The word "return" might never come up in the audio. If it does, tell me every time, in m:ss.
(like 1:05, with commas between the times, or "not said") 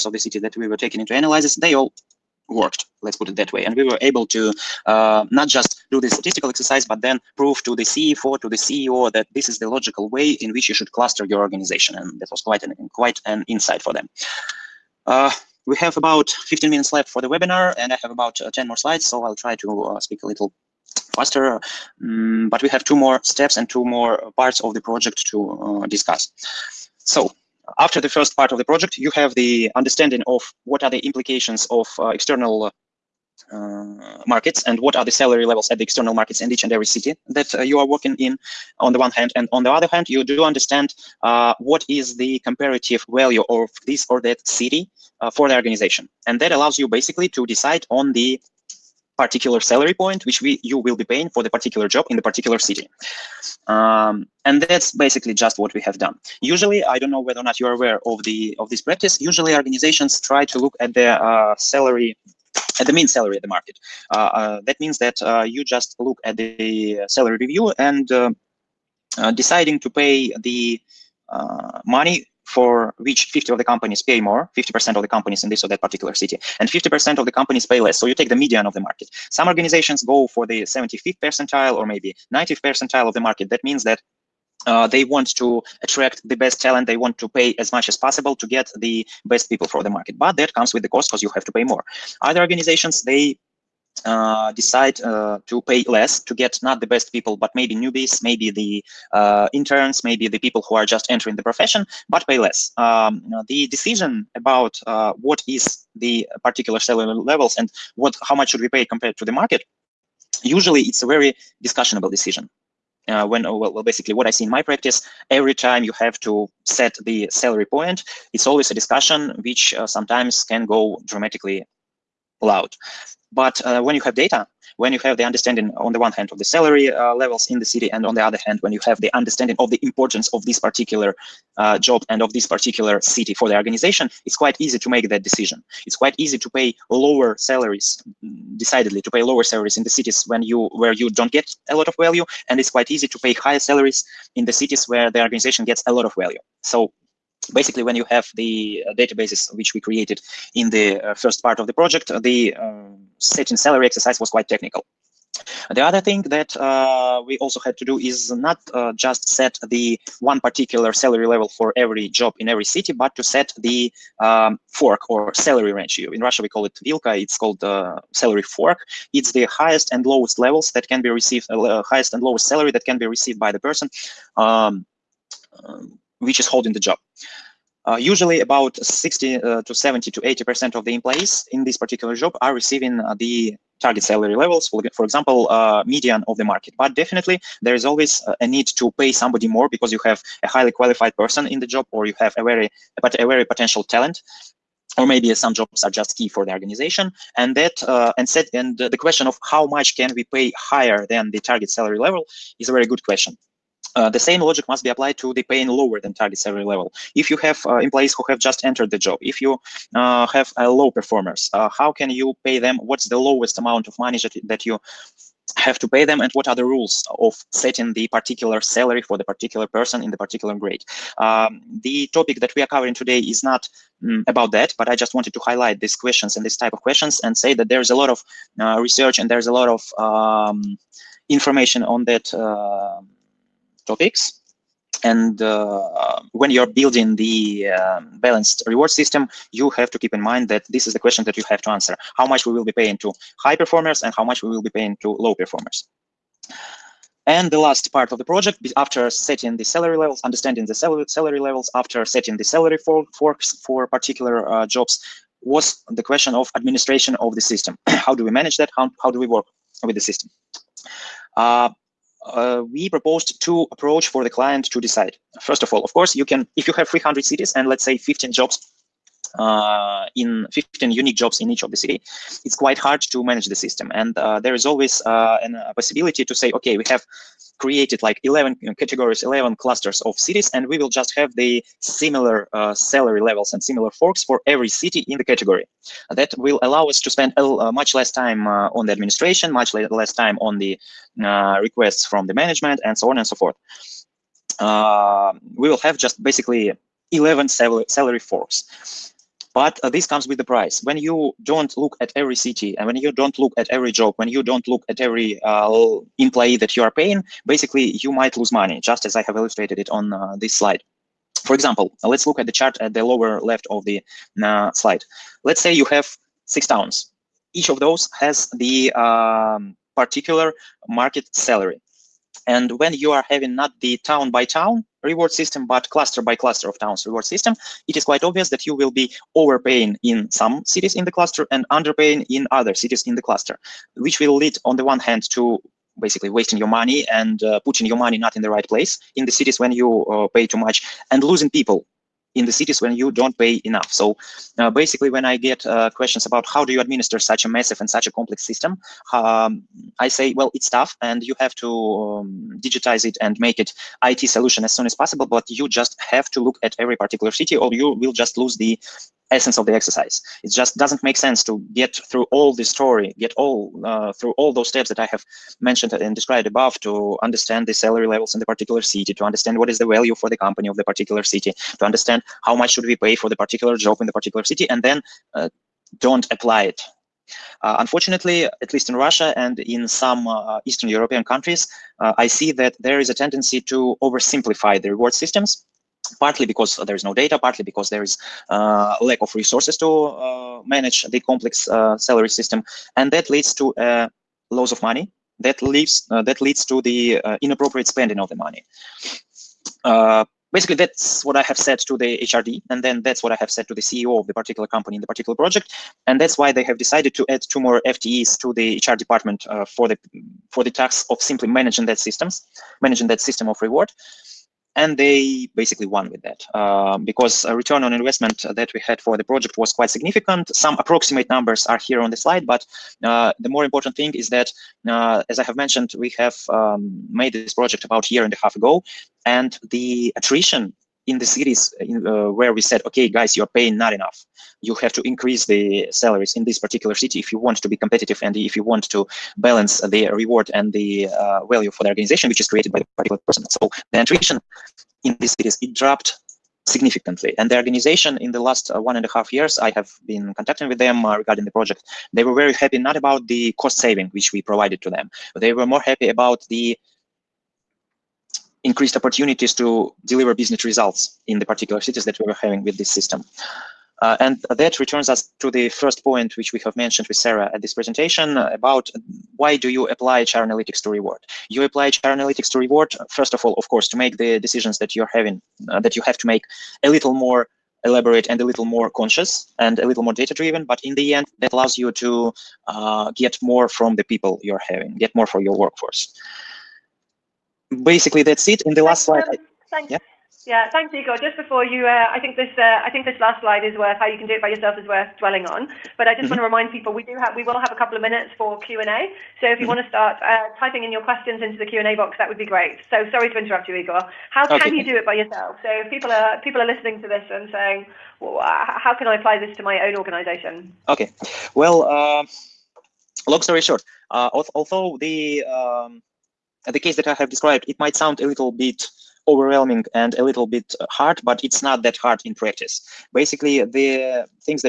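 6:57, 7:44.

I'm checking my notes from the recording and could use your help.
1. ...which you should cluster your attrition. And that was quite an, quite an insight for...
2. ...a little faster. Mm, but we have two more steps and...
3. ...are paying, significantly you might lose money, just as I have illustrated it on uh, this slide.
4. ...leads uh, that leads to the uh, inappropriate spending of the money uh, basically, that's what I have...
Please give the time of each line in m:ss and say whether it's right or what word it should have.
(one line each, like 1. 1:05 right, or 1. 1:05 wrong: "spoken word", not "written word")
1. 0:10 wrong: "organization", not "attrition"
2. 0:20 right
3. 5:06 wrong: "basically", not "significantly"
4. 6:35 right.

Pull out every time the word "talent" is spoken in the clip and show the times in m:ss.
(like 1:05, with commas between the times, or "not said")
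1:26, 3:13.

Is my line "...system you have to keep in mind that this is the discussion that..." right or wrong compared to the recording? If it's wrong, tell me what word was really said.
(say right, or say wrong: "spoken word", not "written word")
wrong: "question", not "discussion".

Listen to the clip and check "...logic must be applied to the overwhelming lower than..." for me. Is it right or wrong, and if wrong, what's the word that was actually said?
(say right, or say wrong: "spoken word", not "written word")
wrong: "paying", not "overwhelming".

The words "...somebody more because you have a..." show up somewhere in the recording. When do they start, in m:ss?
3:09.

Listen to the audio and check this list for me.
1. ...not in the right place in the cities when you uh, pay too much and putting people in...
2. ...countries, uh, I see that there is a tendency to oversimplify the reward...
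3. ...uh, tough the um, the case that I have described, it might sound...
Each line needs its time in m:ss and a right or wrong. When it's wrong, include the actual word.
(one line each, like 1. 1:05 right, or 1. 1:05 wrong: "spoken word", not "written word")
1. 5:38 wrong: "losing", not "putting"
2. 6:21 right
3. 8:34 wrong: "although", not "tough".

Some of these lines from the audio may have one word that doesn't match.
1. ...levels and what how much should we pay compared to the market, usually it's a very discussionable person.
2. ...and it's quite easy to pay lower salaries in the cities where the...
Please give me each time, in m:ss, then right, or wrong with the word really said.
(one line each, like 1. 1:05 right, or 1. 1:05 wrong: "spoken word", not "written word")
1. 1:47 wrong: "decision", not "person"
2. 2:22 wrong: "higher", not "lower".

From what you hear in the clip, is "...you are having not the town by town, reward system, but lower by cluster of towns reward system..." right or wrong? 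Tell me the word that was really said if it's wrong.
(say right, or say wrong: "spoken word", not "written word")
wrong: "cluster", not "lower".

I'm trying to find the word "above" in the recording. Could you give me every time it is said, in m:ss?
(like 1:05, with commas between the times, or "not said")
6:06.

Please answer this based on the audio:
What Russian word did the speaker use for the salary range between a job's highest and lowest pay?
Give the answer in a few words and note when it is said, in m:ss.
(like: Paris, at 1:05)
Vilka, at 2:46.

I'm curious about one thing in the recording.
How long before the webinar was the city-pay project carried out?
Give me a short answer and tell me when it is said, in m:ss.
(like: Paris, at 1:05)
A year and a half ago, at 7:08.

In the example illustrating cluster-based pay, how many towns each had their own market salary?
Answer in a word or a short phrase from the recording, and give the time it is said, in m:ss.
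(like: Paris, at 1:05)
6, at 5:16.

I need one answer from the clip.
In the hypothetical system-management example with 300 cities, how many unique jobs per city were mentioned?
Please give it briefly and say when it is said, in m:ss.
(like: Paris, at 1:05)
15, at 4:30.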